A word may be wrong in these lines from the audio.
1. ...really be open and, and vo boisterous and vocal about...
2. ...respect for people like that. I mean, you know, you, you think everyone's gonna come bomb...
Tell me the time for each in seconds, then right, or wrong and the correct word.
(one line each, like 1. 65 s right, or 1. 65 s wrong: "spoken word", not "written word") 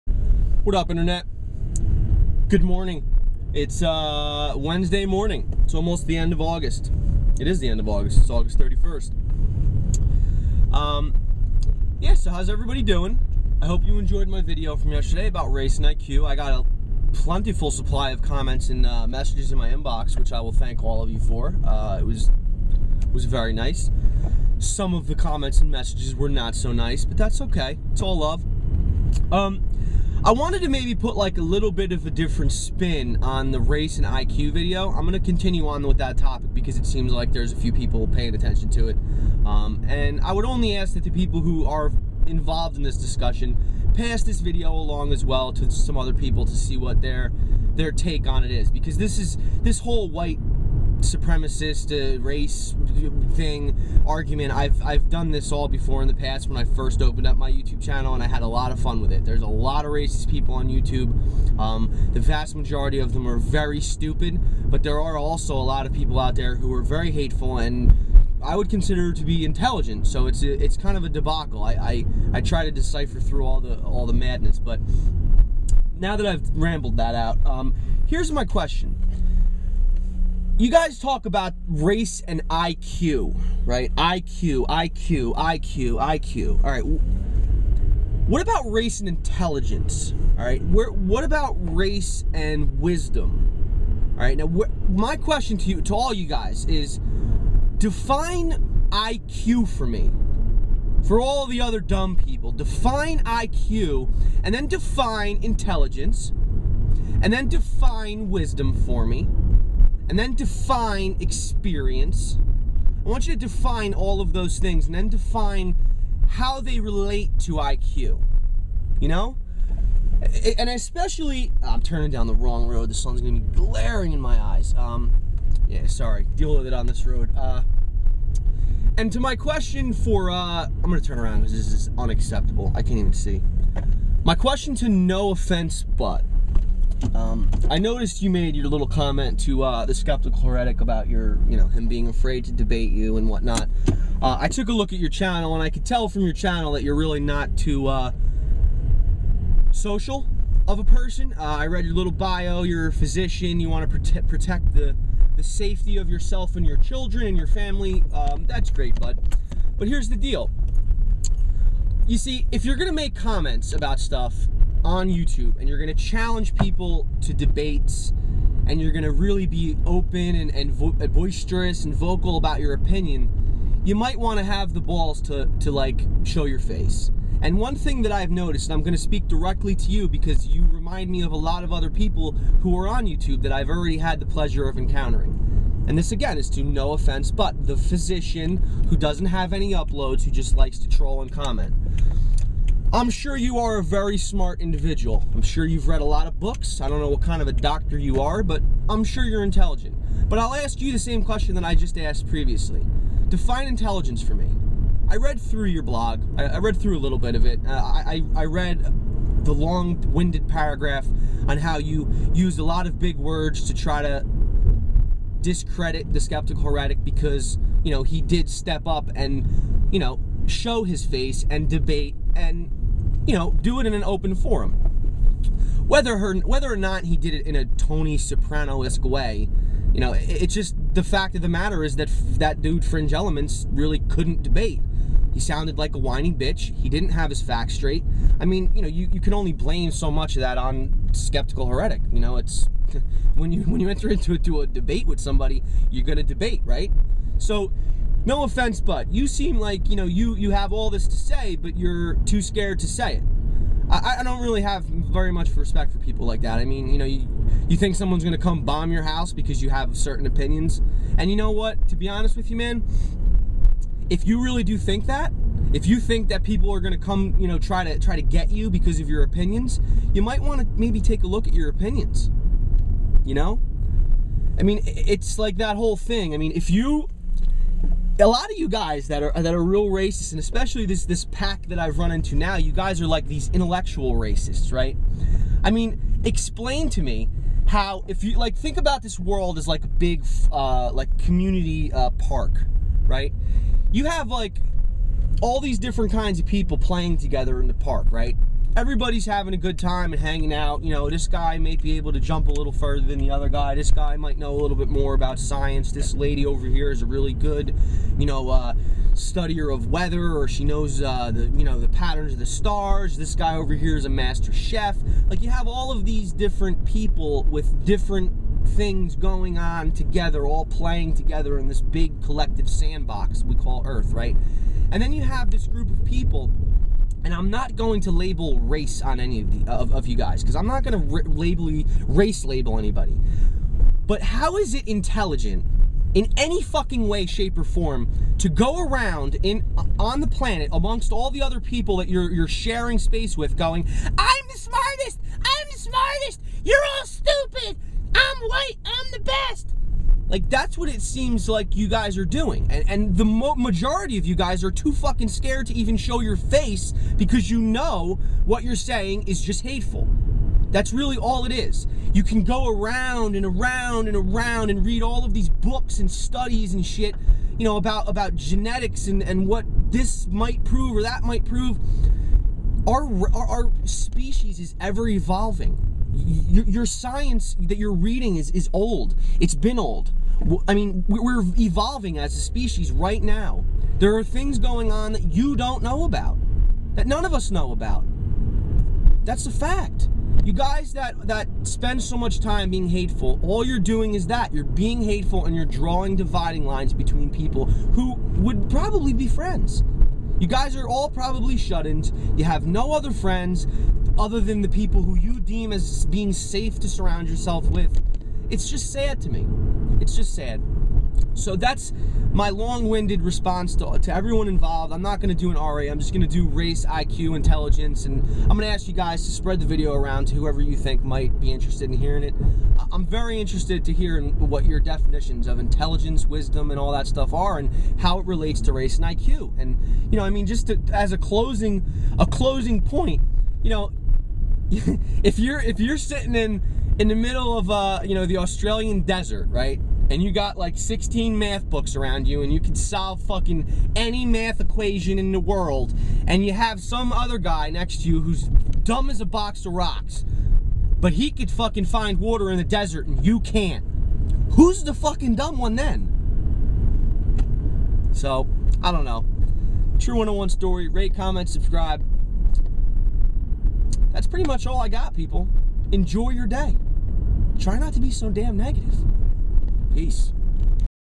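1. 169 s right
2. 255 s wrong: "someone", not "everyone".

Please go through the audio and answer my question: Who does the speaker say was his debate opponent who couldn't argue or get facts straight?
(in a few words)
Fringe Elements.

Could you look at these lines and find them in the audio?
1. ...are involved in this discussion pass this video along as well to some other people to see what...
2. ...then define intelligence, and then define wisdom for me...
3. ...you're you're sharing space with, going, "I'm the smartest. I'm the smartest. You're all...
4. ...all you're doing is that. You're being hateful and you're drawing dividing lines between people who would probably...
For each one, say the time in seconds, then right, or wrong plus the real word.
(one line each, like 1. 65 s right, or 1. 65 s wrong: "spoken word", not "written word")
1. 41 s right
2. 104 s right
3. 342 s right
4. 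393 s right.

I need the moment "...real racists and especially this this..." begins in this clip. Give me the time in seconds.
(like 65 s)
279 s.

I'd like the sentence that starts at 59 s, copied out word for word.
There's a lot of racist people on YouTube.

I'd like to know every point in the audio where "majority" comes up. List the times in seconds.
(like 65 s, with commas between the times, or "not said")
62 s, 353 s.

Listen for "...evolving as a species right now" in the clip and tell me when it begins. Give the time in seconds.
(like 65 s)
381 s.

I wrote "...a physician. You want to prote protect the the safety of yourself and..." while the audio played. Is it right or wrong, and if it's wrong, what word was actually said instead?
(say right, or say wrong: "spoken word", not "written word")
right.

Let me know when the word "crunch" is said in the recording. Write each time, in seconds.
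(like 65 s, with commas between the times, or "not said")
not said.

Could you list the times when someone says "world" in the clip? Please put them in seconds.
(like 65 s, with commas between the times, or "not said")
289 s, 445 s.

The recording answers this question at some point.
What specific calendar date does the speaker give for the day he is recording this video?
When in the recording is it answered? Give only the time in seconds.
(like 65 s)
8 s.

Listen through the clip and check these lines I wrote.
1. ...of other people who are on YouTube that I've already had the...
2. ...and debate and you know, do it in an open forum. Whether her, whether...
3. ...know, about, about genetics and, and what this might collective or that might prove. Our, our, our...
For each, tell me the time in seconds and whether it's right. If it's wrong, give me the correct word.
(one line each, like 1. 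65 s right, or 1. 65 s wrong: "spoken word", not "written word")
1. 181 s right
2. 221 s right
3. 367 s wrong: "prove", not "collective".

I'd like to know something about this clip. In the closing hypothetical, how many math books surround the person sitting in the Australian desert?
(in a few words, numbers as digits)
16.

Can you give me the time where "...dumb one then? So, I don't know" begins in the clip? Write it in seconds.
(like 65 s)
455 s.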